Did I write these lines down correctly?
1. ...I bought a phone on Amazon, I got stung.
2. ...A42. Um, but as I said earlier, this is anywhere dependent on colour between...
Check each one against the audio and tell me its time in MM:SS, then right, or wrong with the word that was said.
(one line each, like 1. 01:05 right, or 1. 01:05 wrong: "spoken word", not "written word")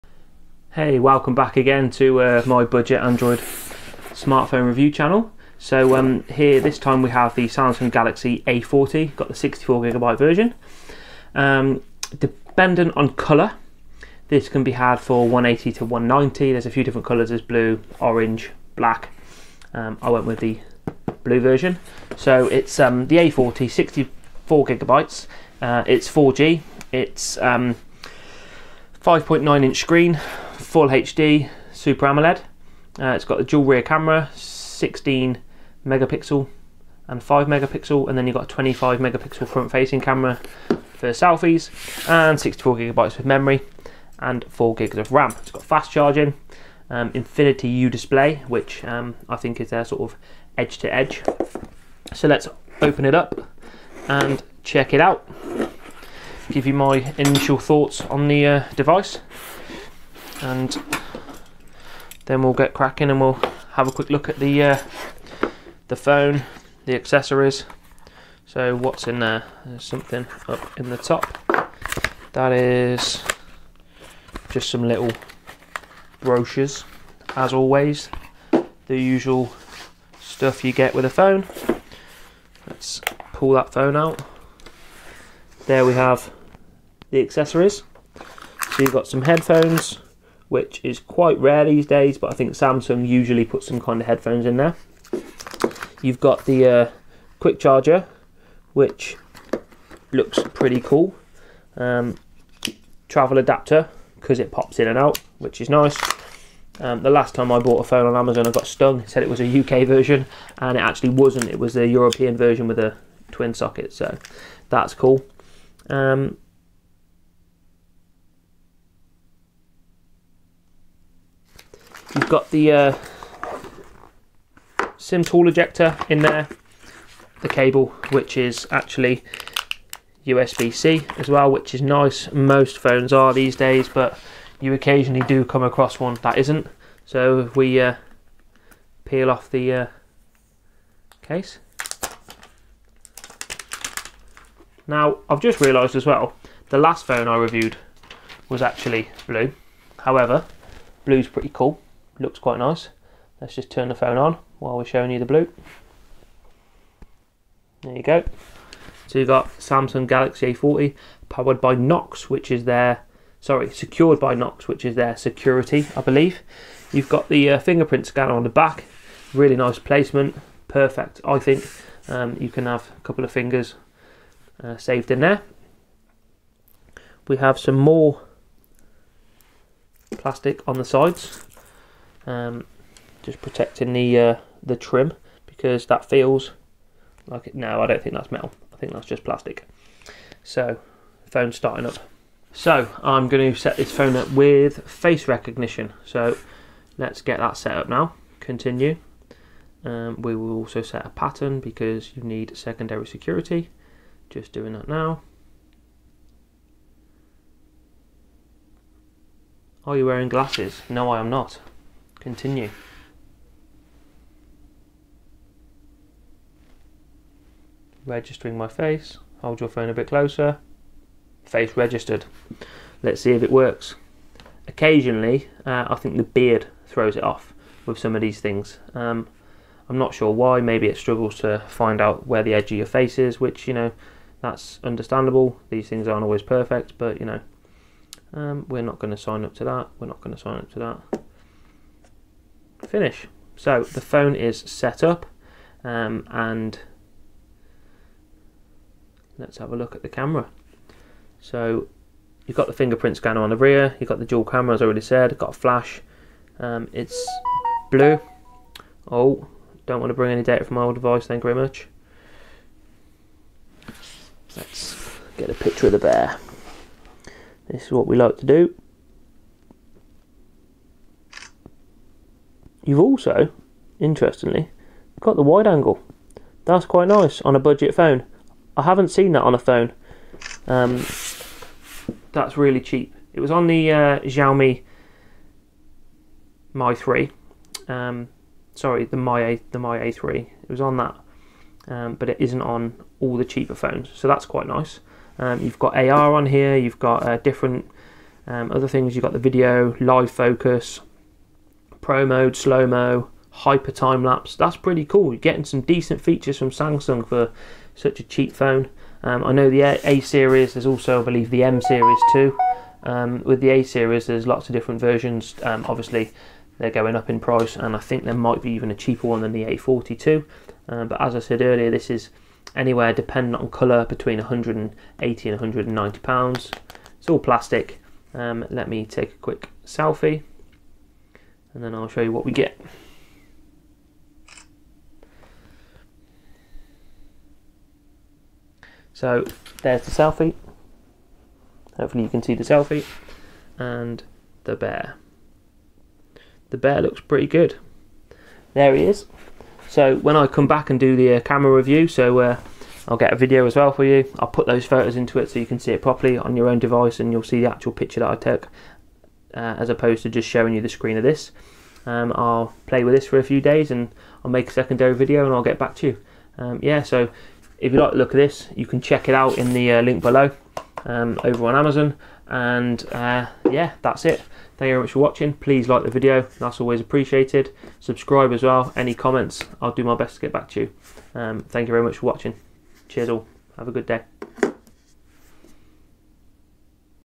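1. 01:47 right
2. 05:19 right.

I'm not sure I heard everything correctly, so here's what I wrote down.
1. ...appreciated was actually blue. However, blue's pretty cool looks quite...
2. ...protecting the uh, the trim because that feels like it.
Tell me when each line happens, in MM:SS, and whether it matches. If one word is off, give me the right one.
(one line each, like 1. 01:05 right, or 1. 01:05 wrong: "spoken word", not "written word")
1. 02:27 wrong: "reviewed", not "appreciated"
2. 03:03 right.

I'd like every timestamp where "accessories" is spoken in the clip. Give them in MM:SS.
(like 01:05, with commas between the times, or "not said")
01:06, 01:27.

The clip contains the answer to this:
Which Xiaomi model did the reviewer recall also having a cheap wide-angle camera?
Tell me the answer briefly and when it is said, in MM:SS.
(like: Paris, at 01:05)
Mi A3, at 04:49.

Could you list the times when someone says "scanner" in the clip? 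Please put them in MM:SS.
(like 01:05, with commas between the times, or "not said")
02:48, 04:13.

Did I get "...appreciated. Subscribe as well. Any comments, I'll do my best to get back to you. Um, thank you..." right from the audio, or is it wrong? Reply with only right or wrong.
right.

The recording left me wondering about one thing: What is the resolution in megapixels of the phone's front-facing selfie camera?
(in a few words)
25.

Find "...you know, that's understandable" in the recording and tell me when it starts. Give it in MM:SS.
03:53.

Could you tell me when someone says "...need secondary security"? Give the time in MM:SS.
03:22.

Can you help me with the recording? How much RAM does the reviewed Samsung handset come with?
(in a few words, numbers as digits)
4 gigs.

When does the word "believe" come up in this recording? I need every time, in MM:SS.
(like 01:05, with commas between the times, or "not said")
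02:46, 05:11.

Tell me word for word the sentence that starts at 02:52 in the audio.
Um, you can have a couple of fingers uh, saved in there.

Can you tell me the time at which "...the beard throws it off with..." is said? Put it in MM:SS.
03:46.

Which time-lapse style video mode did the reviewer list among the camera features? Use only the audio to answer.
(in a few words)
hyper time lapse.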